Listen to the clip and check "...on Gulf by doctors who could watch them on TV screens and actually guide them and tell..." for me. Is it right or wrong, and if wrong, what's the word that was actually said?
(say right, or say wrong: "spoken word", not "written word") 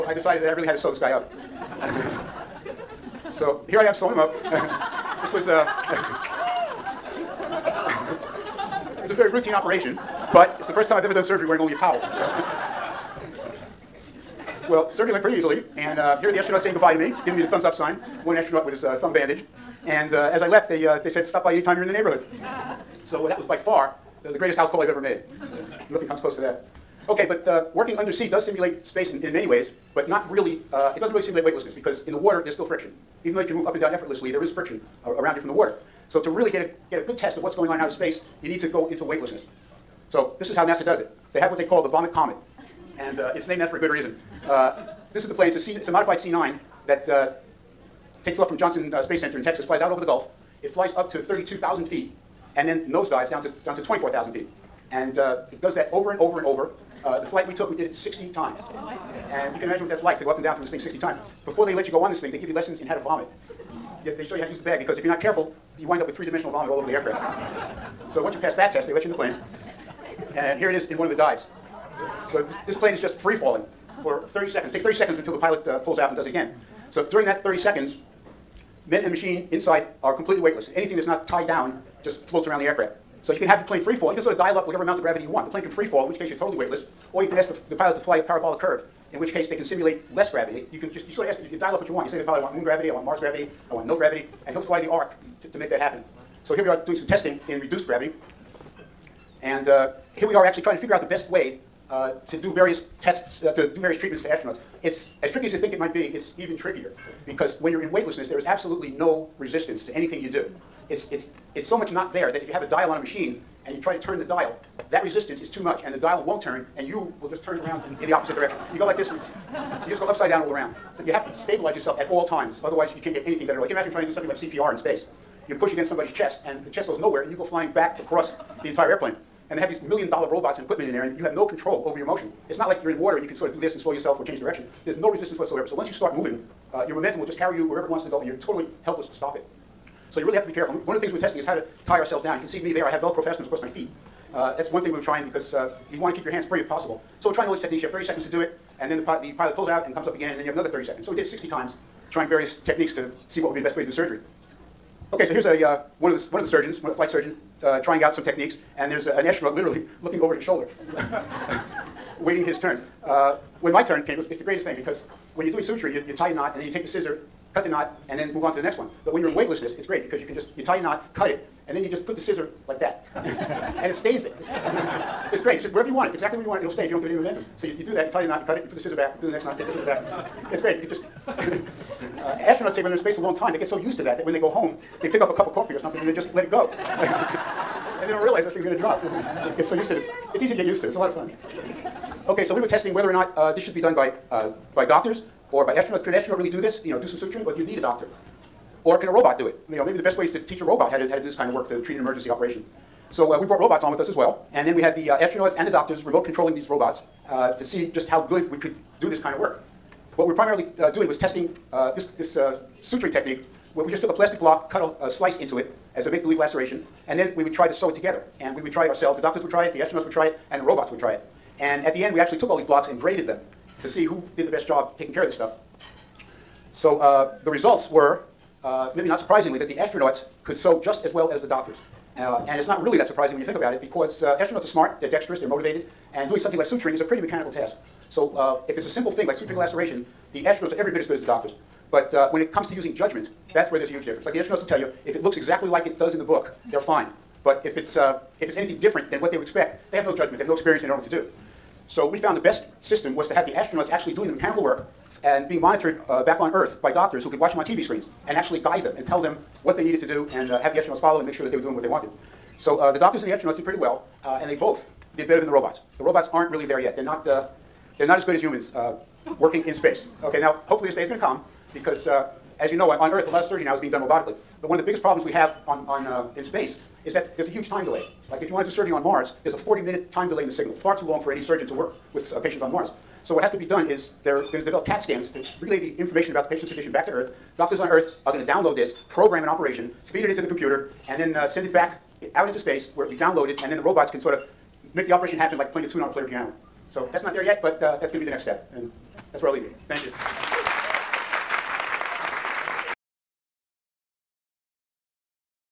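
wrong: "Earth", not "Gulf".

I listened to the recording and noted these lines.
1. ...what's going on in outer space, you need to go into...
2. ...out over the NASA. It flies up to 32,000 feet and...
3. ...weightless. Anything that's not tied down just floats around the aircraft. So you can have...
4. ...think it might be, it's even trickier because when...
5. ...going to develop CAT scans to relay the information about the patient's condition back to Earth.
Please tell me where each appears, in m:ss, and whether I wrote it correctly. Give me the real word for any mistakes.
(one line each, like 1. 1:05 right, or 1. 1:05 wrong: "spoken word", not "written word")
1. 0:37 right
2. 0:49 wrong: "Gulf", not "NASA"
3. 1:20 right
4. 1:45 right
5. 4:44 right.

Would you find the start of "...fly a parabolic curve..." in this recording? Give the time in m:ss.
1:27.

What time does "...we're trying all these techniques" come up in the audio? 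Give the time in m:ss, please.
2:27.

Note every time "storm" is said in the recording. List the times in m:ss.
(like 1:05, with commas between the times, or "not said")
not said.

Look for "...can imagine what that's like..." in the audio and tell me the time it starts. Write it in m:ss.
0:59.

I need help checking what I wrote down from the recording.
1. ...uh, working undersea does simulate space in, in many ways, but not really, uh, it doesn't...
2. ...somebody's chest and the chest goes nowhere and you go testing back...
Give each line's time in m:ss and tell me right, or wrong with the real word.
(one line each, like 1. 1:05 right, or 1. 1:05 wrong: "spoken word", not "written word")
1. 0:27 right
2. 2:05 wrong: "flying", not "testing".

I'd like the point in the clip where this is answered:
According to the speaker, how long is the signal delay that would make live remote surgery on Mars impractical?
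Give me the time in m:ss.
4:39.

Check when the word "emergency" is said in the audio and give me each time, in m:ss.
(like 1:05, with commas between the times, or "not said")
3:21.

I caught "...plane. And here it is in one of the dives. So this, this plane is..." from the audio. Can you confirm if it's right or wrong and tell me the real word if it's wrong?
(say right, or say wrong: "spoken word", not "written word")
right.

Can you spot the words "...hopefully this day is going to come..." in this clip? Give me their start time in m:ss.
4:30.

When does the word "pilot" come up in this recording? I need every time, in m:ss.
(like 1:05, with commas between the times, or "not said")
1:15, 1:27, 1:32, 2:29.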